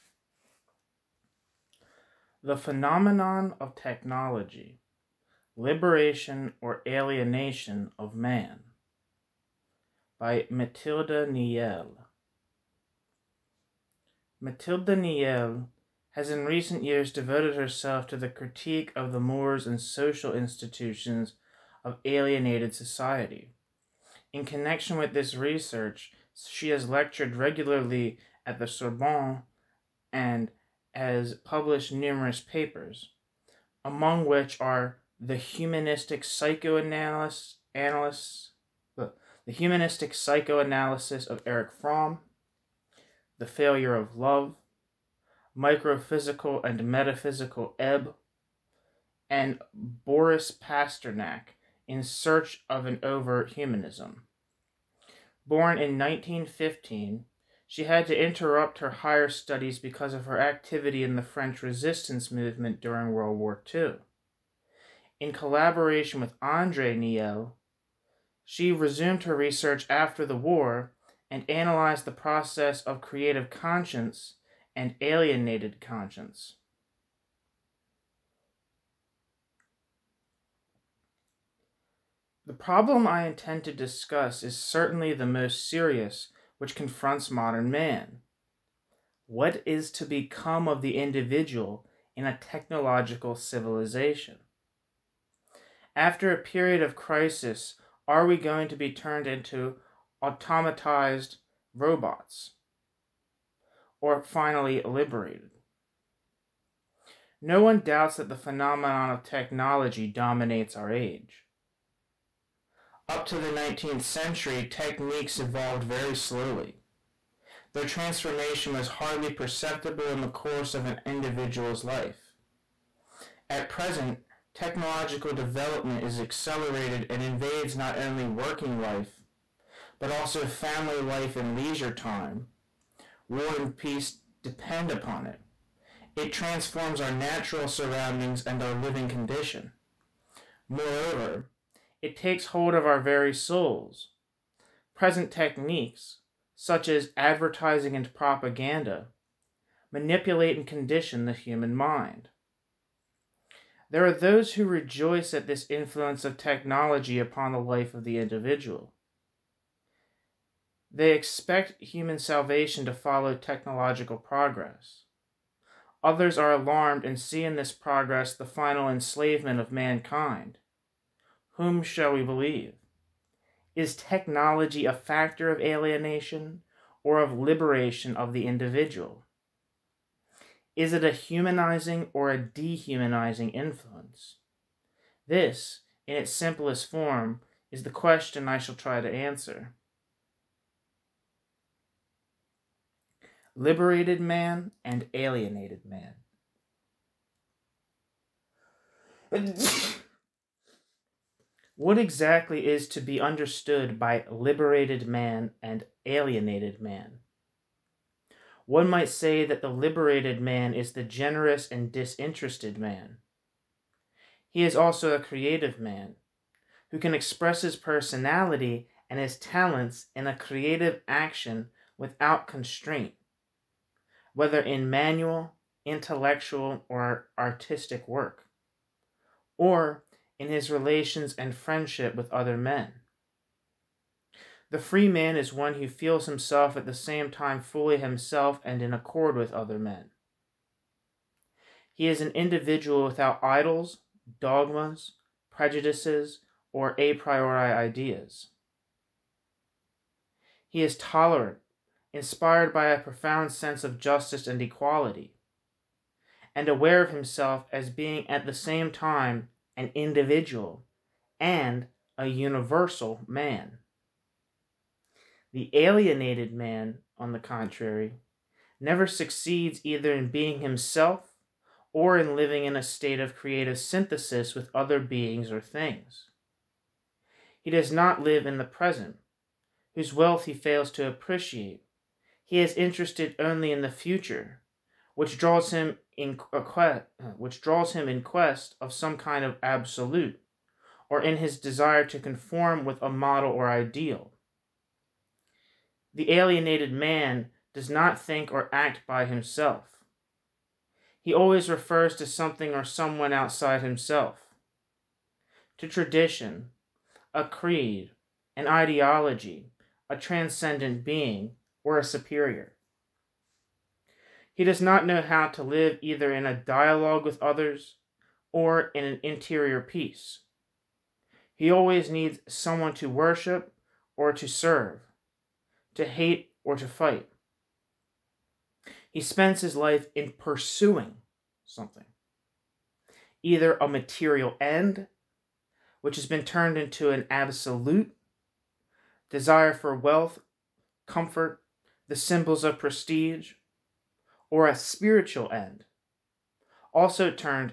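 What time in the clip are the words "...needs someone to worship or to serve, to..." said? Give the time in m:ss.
5:22.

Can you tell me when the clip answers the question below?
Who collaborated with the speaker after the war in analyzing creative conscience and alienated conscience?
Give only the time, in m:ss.
1:06.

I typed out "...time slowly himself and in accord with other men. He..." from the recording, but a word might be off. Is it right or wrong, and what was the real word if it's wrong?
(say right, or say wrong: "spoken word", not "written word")
wrong: "fully", not "slowly".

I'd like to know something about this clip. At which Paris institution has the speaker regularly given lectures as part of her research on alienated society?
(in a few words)
Sorbonne.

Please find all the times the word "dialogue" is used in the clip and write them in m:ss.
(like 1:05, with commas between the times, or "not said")
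5:16.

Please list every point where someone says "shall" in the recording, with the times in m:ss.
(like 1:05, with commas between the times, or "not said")
2:51, 3:08.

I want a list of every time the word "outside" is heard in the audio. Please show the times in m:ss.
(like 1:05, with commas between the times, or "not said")
5:03.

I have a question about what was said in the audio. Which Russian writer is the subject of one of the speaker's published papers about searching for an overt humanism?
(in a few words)
Boris Pasternak.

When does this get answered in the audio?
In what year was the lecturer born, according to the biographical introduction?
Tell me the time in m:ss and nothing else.
0:55.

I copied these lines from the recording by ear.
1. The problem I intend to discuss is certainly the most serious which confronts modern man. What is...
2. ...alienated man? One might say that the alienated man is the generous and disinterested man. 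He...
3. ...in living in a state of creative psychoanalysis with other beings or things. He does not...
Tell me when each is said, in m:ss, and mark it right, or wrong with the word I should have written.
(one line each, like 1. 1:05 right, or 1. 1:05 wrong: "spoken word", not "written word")
1. 1:22 right
2. 3:26 wrong: "liberated", not "alienated"
3. 4:32 wrong: "synthesis", not "psychoanalysis".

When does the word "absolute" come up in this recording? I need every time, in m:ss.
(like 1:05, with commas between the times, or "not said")
4:49, 5:37.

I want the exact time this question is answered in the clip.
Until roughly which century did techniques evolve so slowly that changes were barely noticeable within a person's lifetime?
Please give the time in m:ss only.
1:53.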